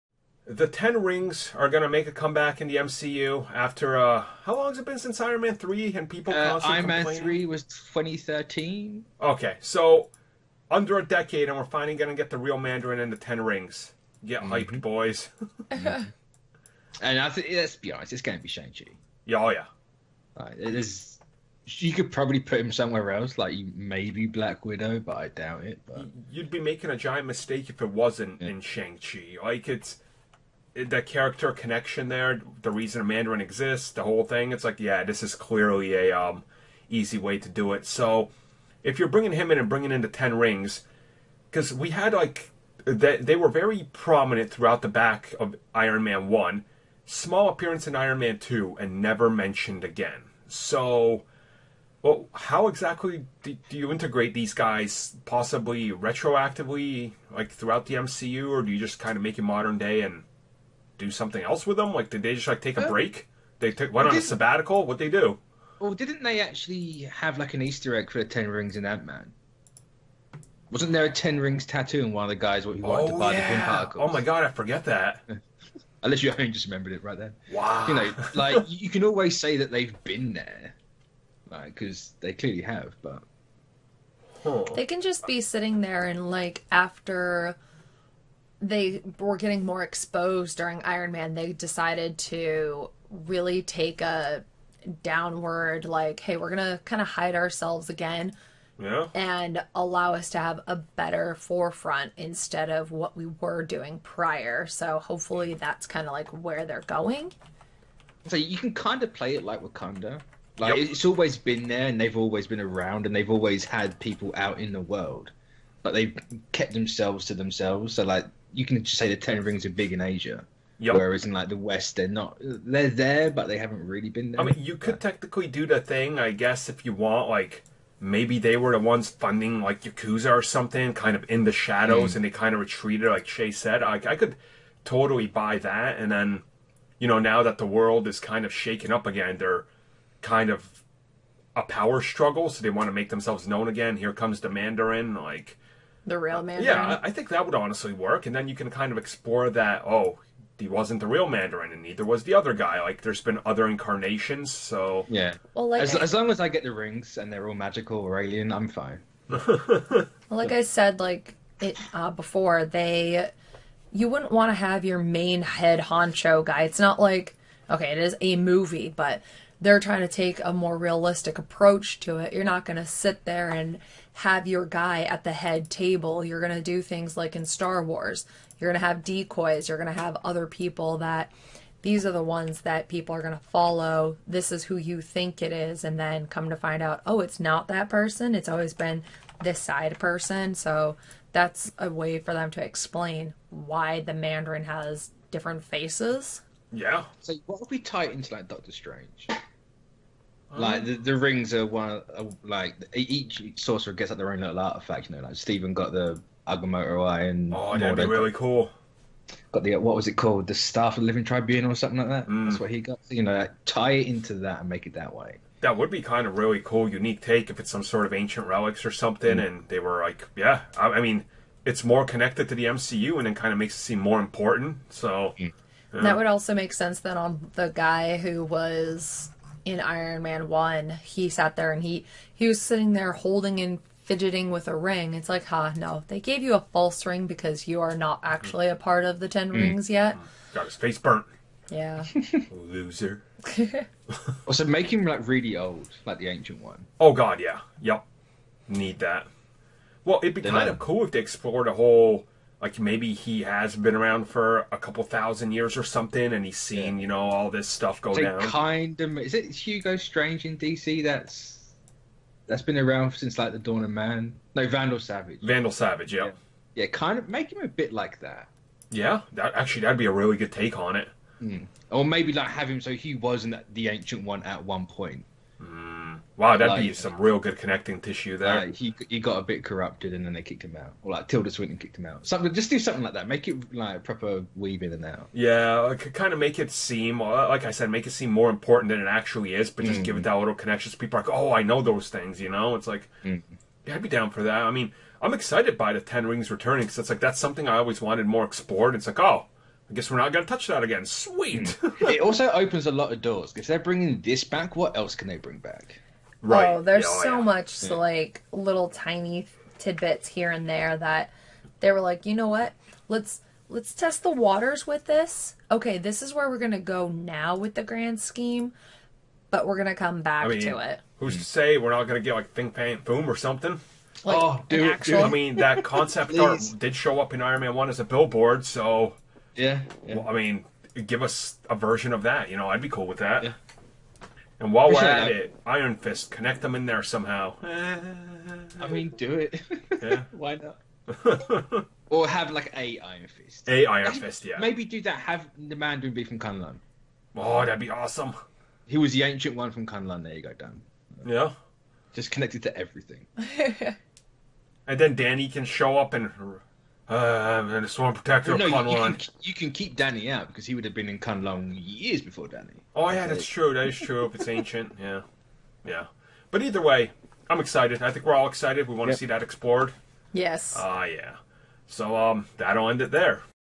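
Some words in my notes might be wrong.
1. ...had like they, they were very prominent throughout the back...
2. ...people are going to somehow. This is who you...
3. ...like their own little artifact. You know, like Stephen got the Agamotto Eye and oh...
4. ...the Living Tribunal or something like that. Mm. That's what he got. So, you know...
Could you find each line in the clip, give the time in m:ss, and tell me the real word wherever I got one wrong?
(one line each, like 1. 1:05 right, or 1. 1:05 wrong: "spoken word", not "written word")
1. 0:41 right
2. 3:02 wrong: "follow", not "somehow"
3. 3:24 right
4. 3:31 right.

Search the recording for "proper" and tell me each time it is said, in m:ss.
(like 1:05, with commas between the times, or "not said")
4:44.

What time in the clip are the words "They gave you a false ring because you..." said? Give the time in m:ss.
3:56.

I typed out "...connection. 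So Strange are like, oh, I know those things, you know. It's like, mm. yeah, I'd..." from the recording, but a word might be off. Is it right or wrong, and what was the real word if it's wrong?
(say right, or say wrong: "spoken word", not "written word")
wrong: "People", not "Strange".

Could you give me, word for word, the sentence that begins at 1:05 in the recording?
Well, didn't they actually have like an Easter egg for the Ten Rings in Ant Man?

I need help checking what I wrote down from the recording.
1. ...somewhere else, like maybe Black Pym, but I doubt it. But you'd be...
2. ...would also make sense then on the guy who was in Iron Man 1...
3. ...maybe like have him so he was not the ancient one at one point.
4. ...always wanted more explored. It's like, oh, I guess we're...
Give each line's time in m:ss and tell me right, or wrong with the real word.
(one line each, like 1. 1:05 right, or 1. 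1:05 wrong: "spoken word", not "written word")
1. 0:22 wrong: "Widow", not "Pym"
2. 3:46 right
3. 4:32 right
4. 4:57 right.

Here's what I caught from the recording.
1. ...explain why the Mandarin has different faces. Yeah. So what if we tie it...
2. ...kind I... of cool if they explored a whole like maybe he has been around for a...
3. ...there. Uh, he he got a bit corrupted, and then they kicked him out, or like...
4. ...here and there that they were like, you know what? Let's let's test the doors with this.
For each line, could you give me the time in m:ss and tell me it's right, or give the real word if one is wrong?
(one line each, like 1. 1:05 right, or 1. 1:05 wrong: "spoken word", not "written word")
1. 3:12 right
2. 4:10 right
3. 4:38 right
4. 5:10 wrong: "waters", not "doors".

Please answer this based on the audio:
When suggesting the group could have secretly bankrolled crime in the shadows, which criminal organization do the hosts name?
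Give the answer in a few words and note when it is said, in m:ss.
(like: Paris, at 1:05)
Yakuza, at 2:09.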